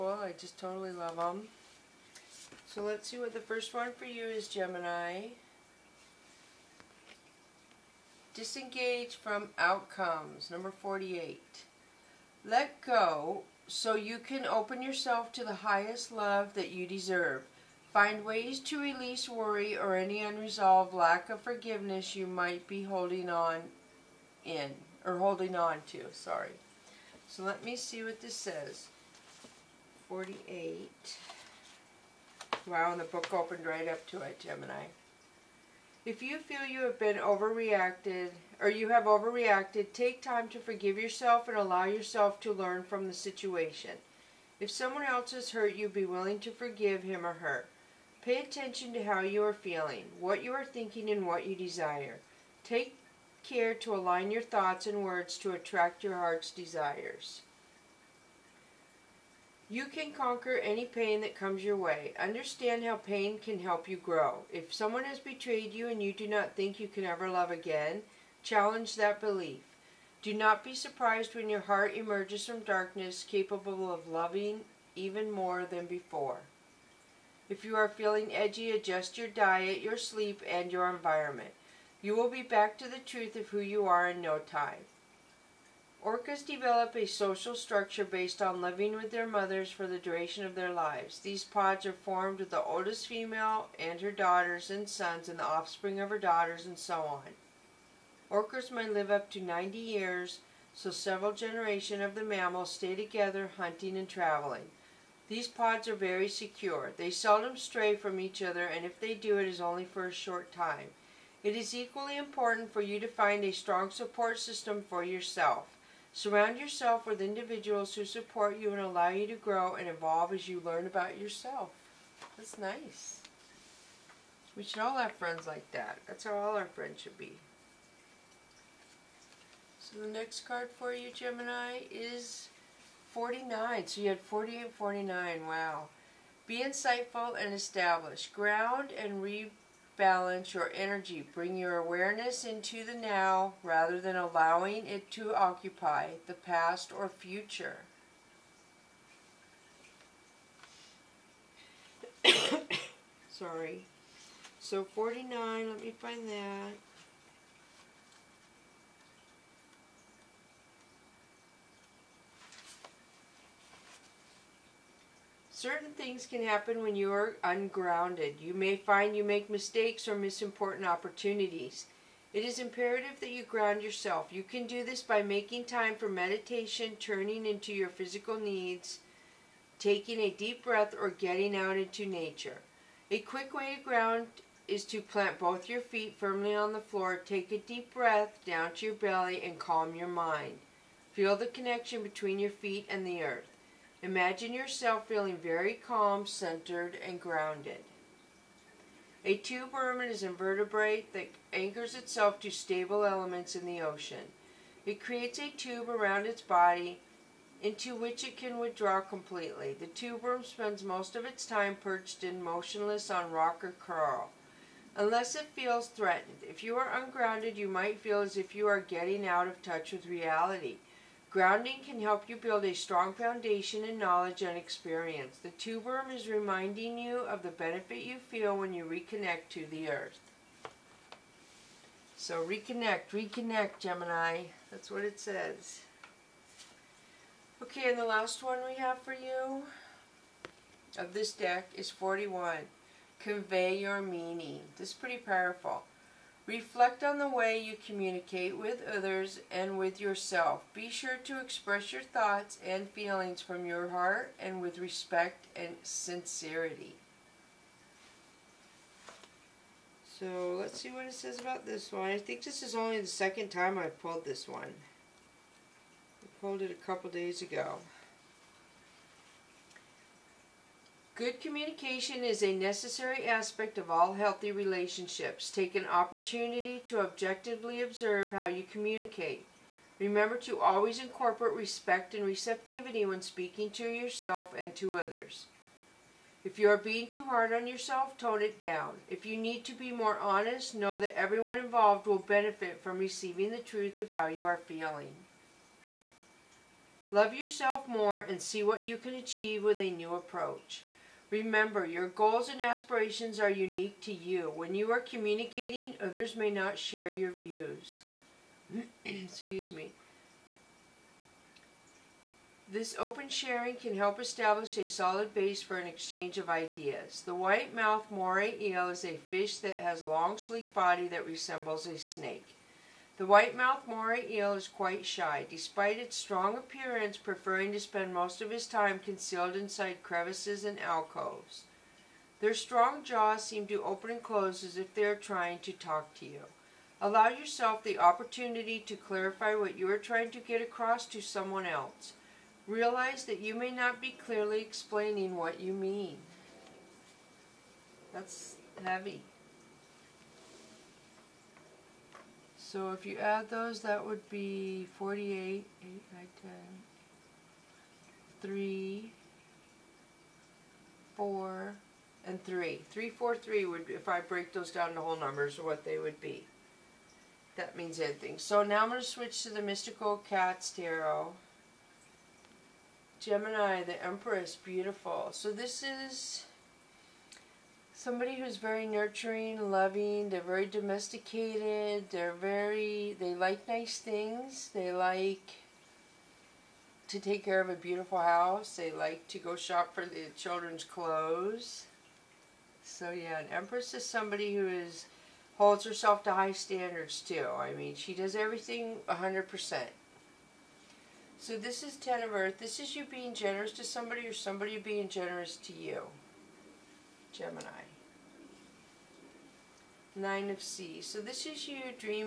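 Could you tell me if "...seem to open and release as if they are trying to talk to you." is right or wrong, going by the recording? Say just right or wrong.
wrong.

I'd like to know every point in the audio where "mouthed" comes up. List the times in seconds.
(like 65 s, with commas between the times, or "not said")
317 s, 323 s.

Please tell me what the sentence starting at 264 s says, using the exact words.
I pulled it a couple days ago.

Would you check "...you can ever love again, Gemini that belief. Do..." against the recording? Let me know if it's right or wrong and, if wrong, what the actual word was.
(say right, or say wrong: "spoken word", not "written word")
wrong: "Challenge", not "Gemini".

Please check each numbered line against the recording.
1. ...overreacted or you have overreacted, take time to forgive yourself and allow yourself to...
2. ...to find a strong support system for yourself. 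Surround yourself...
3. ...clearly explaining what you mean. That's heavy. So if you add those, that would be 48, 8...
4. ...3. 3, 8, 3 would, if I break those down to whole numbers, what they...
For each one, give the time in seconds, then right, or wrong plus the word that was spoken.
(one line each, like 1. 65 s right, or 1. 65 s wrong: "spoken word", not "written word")
1. 37 s right
2. 112 s right
3. 344 s right
4. 362 s wrong: "4", not "8".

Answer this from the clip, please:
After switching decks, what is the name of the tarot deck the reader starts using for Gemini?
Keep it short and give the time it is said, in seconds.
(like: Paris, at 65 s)
Mystical Cats Tarot, at 369 s.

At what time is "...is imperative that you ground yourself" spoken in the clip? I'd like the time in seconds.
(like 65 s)
172 s.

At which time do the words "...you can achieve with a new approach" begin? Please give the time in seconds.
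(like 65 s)
298 s.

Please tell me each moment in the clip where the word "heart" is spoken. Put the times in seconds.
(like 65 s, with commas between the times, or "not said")
56 s, 71 s, 253 s.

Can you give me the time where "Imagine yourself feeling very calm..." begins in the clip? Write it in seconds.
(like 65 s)
194 s.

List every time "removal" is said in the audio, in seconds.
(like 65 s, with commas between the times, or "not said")
not said.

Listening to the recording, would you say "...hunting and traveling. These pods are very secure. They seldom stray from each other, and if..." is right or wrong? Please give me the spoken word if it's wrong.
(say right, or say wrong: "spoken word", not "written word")
right.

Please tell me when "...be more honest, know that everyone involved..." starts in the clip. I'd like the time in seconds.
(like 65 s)
289 s.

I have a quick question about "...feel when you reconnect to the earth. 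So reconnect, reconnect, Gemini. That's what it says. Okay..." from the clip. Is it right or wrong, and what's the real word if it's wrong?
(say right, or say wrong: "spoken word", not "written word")
right.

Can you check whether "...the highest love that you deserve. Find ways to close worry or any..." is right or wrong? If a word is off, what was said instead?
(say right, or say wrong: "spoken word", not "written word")
wrong: "release", not "close".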